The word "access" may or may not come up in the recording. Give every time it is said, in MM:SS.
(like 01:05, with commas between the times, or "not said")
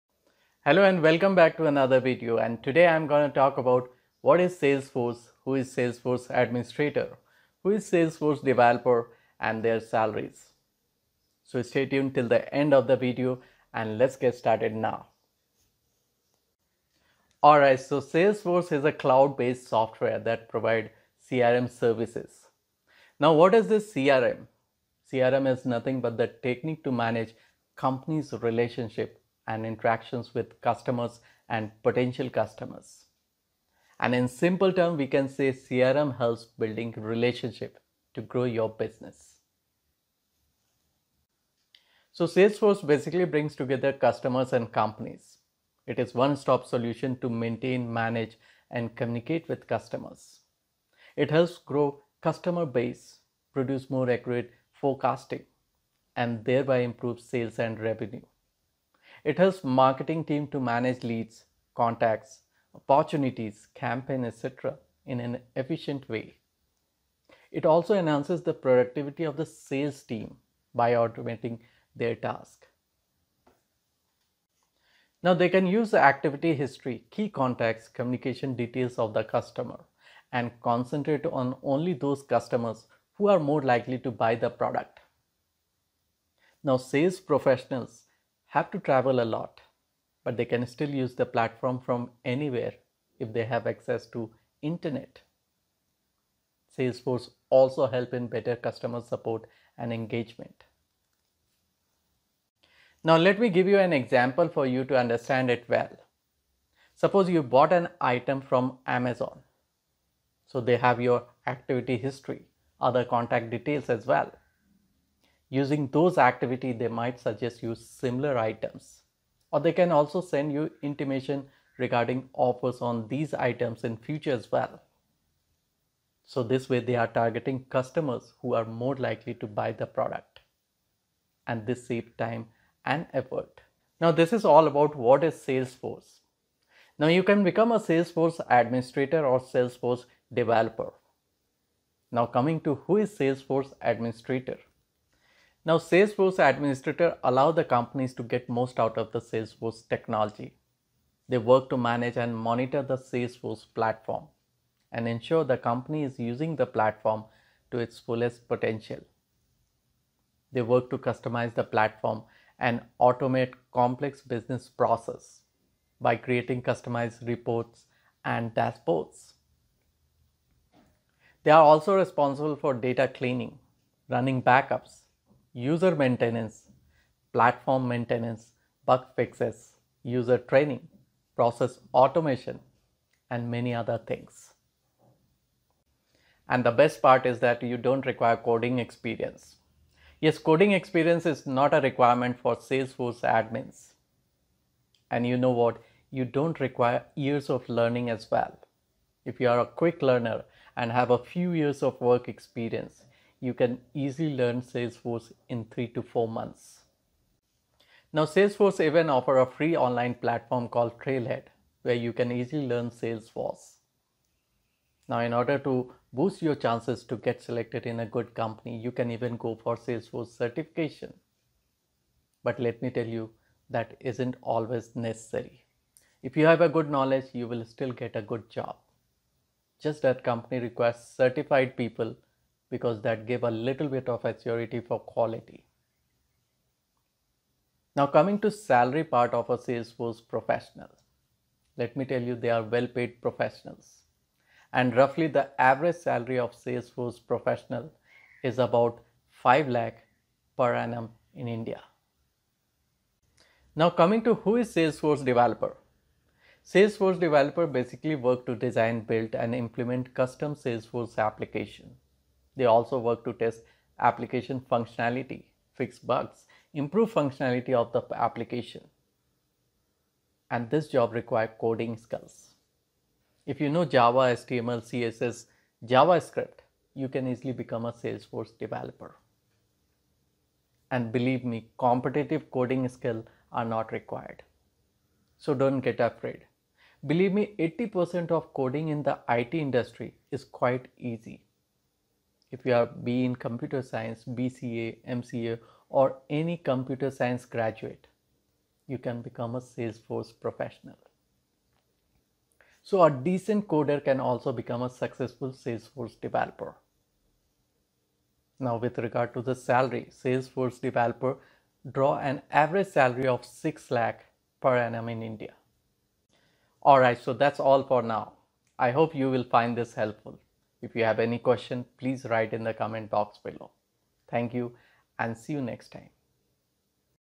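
01:33.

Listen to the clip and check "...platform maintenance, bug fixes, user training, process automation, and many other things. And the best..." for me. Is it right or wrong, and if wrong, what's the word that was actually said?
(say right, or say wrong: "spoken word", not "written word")
right.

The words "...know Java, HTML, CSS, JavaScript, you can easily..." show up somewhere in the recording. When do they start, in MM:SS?
04:33.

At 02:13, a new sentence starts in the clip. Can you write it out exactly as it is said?
Now this is all about what is Salesforce.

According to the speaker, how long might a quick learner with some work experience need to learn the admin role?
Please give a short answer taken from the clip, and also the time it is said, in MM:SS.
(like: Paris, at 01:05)
3 to 4 months, at 03:25.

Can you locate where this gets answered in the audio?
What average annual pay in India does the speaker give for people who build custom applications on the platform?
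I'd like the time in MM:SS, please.
05:13.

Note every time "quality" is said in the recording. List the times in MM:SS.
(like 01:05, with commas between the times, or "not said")
03:55.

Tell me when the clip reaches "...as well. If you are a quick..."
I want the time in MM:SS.
03:18.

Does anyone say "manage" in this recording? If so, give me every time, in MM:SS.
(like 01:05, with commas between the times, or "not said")
00:26, 00:47, 01:00, 02:31.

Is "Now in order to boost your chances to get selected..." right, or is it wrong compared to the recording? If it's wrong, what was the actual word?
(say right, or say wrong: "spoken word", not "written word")
right.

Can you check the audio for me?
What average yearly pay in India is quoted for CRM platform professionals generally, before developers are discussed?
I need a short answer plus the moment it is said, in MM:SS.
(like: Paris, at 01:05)
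5 lakh per annum, at 04:09.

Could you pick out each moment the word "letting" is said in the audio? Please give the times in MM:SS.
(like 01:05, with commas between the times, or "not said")
not said.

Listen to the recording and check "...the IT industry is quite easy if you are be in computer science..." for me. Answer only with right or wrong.
right.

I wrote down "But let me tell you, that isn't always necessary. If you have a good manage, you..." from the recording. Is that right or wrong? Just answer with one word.
wrong.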